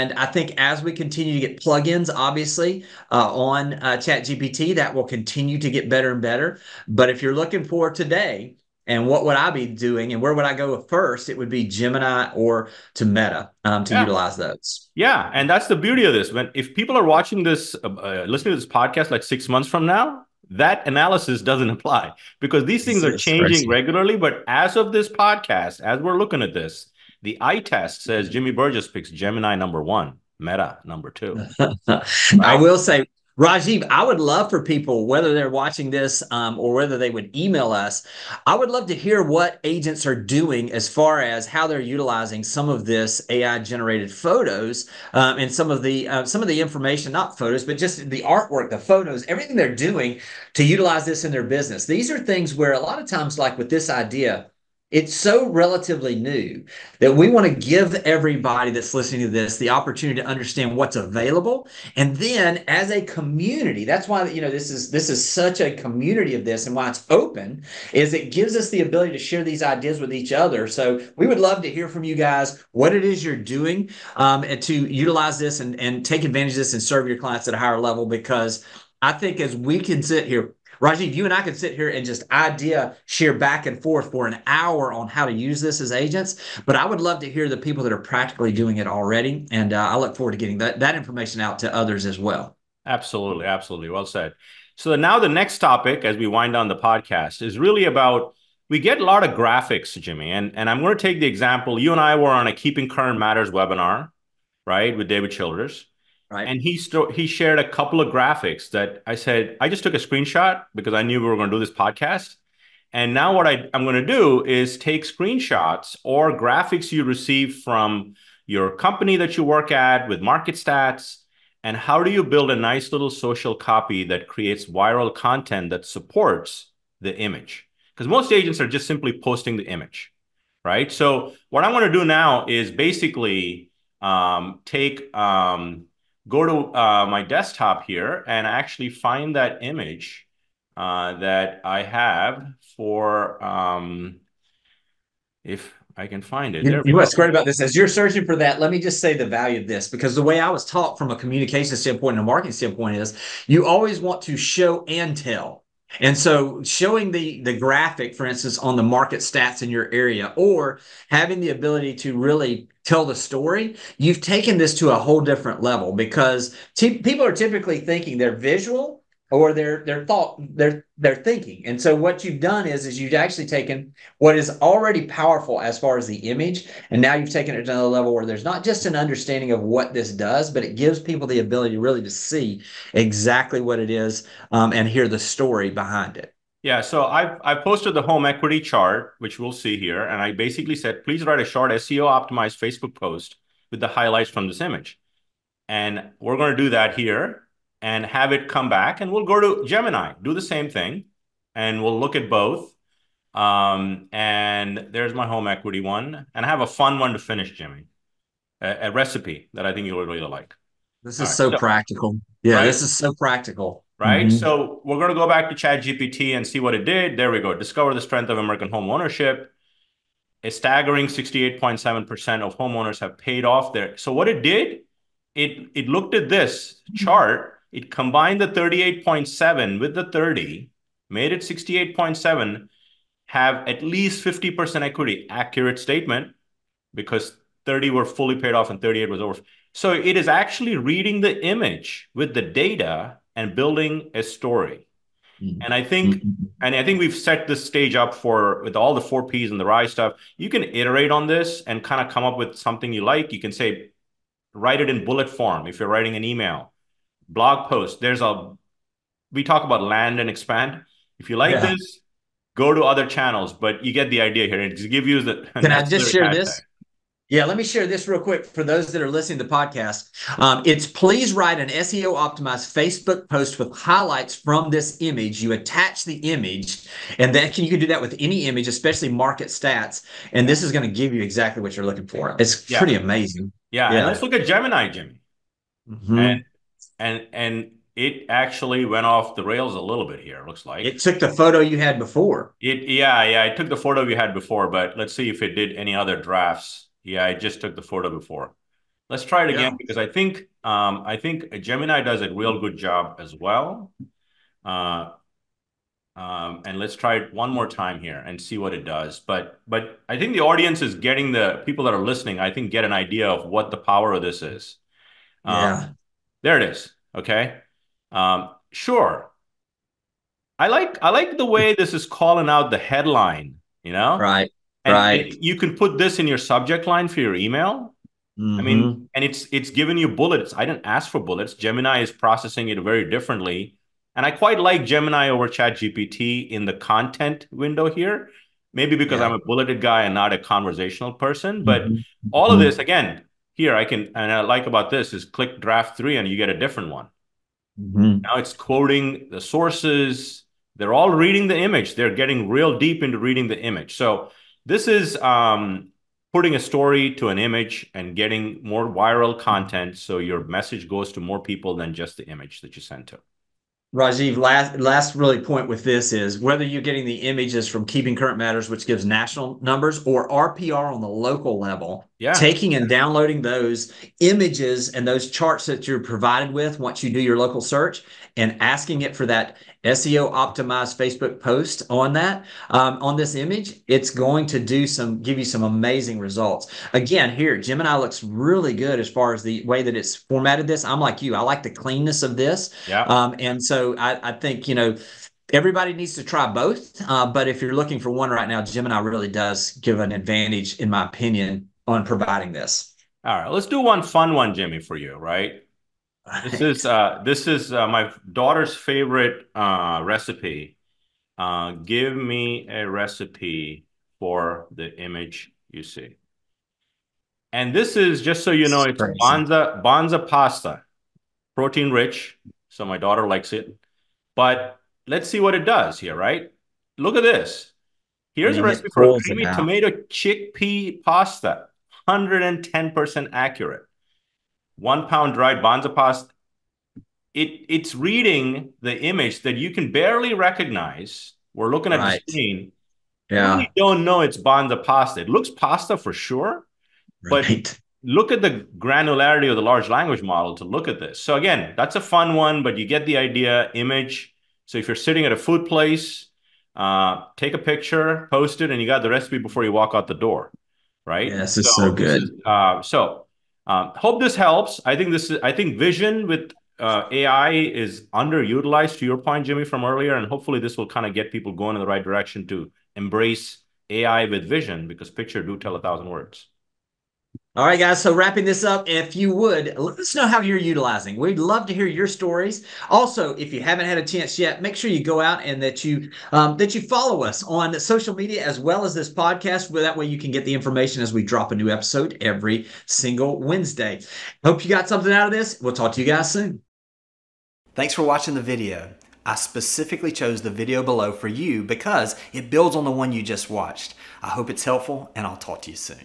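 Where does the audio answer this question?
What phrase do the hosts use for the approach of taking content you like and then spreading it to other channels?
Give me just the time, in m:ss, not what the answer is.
4:19.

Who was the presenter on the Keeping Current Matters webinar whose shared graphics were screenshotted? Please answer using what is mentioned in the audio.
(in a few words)
David Childers.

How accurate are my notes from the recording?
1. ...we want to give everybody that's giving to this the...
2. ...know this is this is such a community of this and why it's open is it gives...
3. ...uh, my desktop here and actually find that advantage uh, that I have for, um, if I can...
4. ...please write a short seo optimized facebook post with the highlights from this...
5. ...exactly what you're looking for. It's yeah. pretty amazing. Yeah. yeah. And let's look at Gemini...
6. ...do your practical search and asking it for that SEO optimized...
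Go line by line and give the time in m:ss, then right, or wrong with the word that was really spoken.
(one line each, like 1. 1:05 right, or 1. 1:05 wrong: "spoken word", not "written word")
1. 0:57 wrong: "listening", not "giving"
2. 1:04 right
3. 2:16 wrong: "image", not "advantage"
4. 3:11 right
5. 4:41 right
6. 6:17 wrong: "local", not "practical".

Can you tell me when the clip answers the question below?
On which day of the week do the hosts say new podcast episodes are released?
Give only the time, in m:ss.
8:13.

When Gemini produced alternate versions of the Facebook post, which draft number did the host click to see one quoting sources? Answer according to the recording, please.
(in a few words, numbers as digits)
3.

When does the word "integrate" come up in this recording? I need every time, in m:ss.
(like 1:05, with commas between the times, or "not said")
not said.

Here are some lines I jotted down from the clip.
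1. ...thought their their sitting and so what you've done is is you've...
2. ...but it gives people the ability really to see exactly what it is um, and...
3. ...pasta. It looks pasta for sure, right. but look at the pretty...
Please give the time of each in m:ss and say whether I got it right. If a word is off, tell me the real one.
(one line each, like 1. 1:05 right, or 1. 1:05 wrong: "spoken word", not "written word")
1. 2:50 wrong: "thinking", not "sitting"
2. 3:00 right
3. 7:24 wrong: "granularity", not "pretty".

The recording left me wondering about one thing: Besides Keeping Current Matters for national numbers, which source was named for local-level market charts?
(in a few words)
RPR.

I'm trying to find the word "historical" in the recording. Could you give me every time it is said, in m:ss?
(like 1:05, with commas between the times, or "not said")
not said.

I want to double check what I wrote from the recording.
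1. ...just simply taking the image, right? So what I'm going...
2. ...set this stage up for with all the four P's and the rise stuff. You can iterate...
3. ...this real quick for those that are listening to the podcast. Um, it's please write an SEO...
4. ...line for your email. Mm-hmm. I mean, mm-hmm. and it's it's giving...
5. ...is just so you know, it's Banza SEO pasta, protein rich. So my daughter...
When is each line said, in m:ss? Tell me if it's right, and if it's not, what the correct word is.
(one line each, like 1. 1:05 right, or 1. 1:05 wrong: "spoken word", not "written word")
1. 2:08 wrong: "posting", not "taking"
2. 4:07 right
3. 4:27 right
4. 5:26 right
5. 6:57 wrong: "Banza", not "SEO".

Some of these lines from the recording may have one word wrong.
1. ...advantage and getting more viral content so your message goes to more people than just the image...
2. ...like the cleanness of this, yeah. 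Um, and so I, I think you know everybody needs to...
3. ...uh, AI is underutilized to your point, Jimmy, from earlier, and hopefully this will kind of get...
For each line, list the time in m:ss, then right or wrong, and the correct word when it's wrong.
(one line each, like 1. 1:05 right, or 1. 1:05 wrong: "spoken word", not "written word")
1. 5:57 wrong: "image", not "advantage"
2. 6:31 right
3. 7:46 right.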